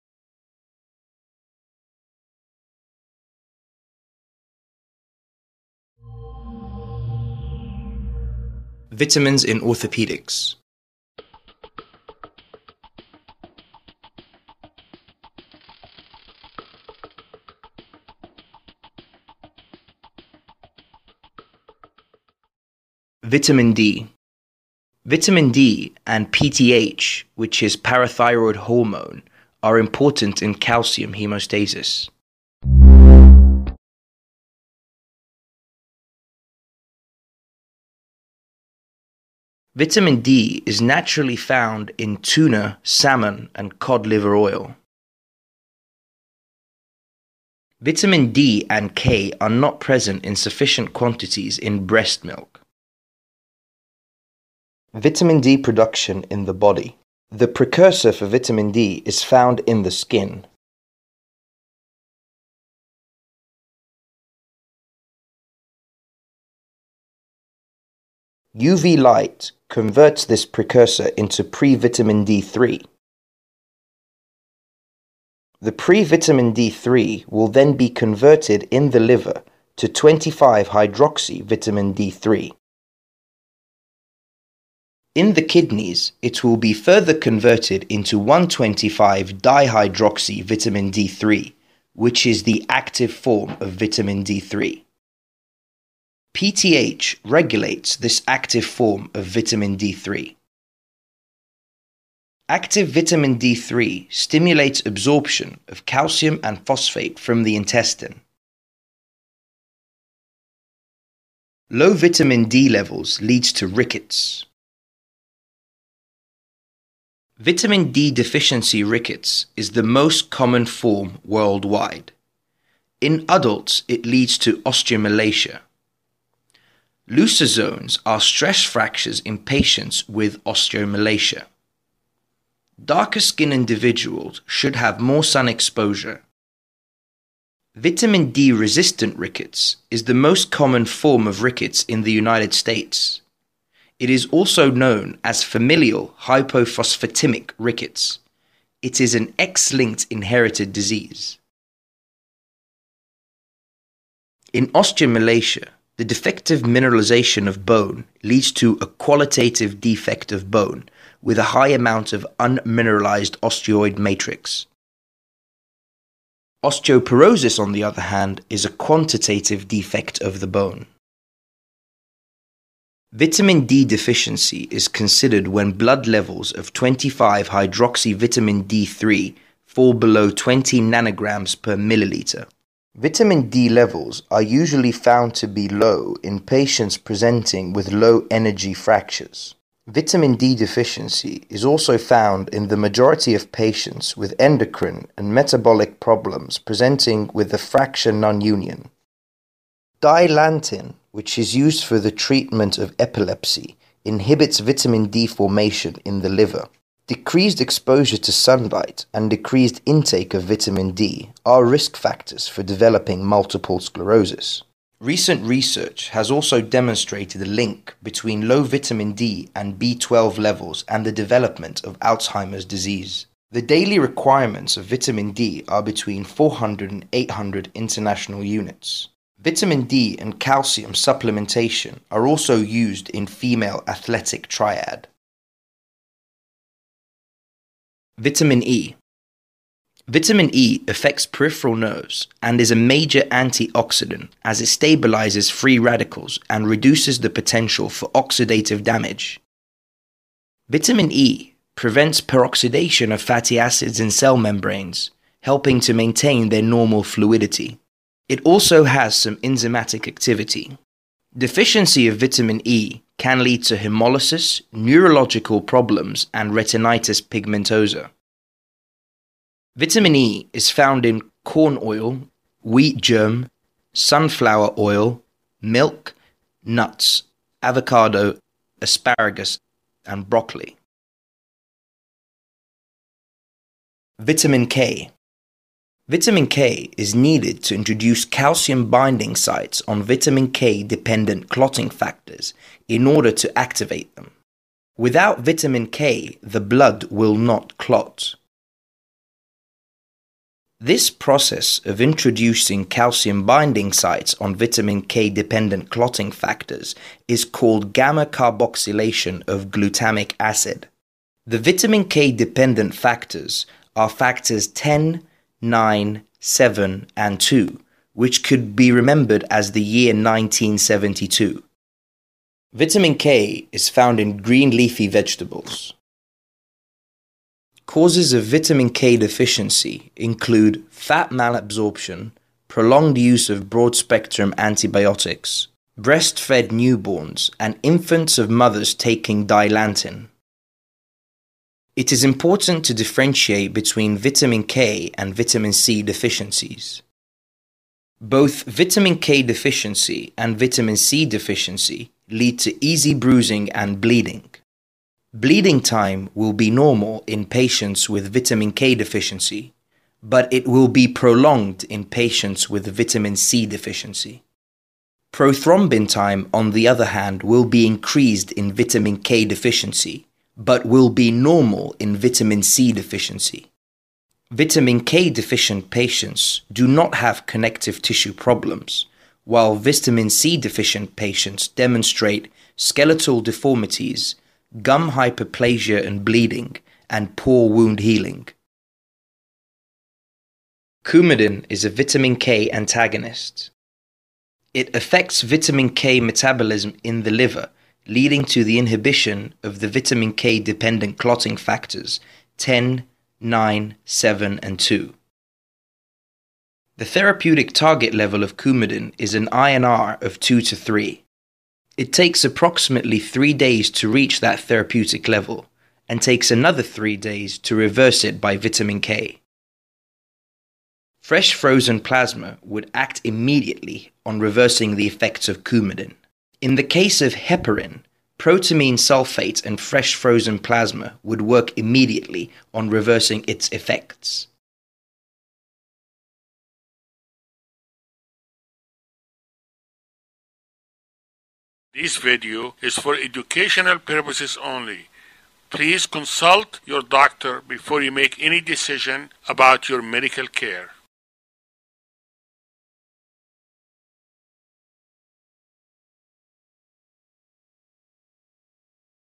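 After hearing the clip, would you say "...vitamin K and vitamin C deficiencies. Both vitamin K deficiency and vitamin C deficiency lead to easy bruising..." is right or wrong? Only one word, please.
right.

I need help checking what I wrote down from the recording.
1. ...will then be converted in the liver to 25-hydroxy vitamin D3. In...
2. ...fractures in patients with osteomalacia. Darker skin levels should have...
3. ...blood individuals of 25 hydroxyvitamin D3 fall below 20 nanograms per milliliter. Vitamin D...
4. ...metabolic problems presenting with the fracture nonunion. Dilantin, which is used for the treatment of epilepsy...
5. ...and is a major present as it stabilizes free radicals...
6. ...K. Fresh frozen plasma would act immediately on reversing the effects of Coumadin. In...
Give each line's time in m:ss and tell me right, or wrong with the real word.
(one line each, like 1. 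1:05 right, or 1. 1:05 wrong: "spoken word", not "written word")
1. 1:17 right
2. 2:08 wrong: "individuals", not "levels"
3. 2:55 wrong: "levels", not "individuals"
4. 3:15 right
5. 4:02 wrong: "antioxidant", not "present"
6. 6:58 right.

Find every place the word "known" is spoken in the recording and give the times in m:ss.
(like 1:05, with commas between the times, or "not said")
2:24.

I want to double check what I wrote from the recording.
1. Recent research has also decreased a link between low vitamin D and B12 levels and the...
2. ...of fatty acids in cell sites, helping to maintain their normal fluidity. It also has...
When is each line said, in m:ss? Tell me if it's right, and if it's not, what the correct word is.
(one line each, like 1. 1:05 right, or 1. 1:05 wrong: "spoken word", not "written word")
1. 3:35 wrong: "demonstrated", not "decreased"
2. 4:13 wrong: "membranes", not "sites".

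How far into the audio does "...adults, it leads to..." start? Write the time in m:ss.
2:03.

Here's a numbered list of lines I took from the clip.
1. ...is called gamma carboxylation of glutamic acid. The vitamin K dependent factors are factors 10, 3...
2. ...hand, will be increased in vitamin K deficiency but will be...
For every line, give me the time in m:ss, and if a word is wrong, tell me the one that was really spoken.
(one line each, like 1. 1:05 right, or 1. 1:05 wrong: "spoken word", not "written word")
1. 5:07 wrong: "9", not "3"
2. 6:07 right.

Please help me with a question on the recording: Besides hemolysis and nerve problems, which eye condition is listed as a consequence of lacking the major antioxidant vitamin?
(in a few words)
retinitis pigmentosa.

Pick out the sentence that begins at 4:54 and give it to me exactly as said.
Without vitamin K, the blood will not clot.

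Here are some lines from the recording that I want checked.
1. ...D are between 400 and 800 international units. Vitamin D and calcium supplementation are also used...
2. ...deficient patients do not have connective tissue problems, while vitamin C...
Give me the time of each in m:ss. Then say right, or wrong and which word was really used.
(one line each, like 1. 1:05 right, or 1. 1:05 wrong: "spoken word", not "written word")
1. 3:45 right
2. 6:15 right.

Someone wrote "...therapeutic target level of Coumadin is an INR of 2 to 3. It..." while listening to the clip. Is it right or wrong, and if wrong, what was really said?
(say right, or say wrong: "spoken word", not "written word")
right.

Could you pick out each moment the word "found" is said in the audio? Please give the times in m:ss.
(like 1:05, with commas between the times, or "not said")
0:41, 0:59, 3:04, 3:11, 4:30, 5:23.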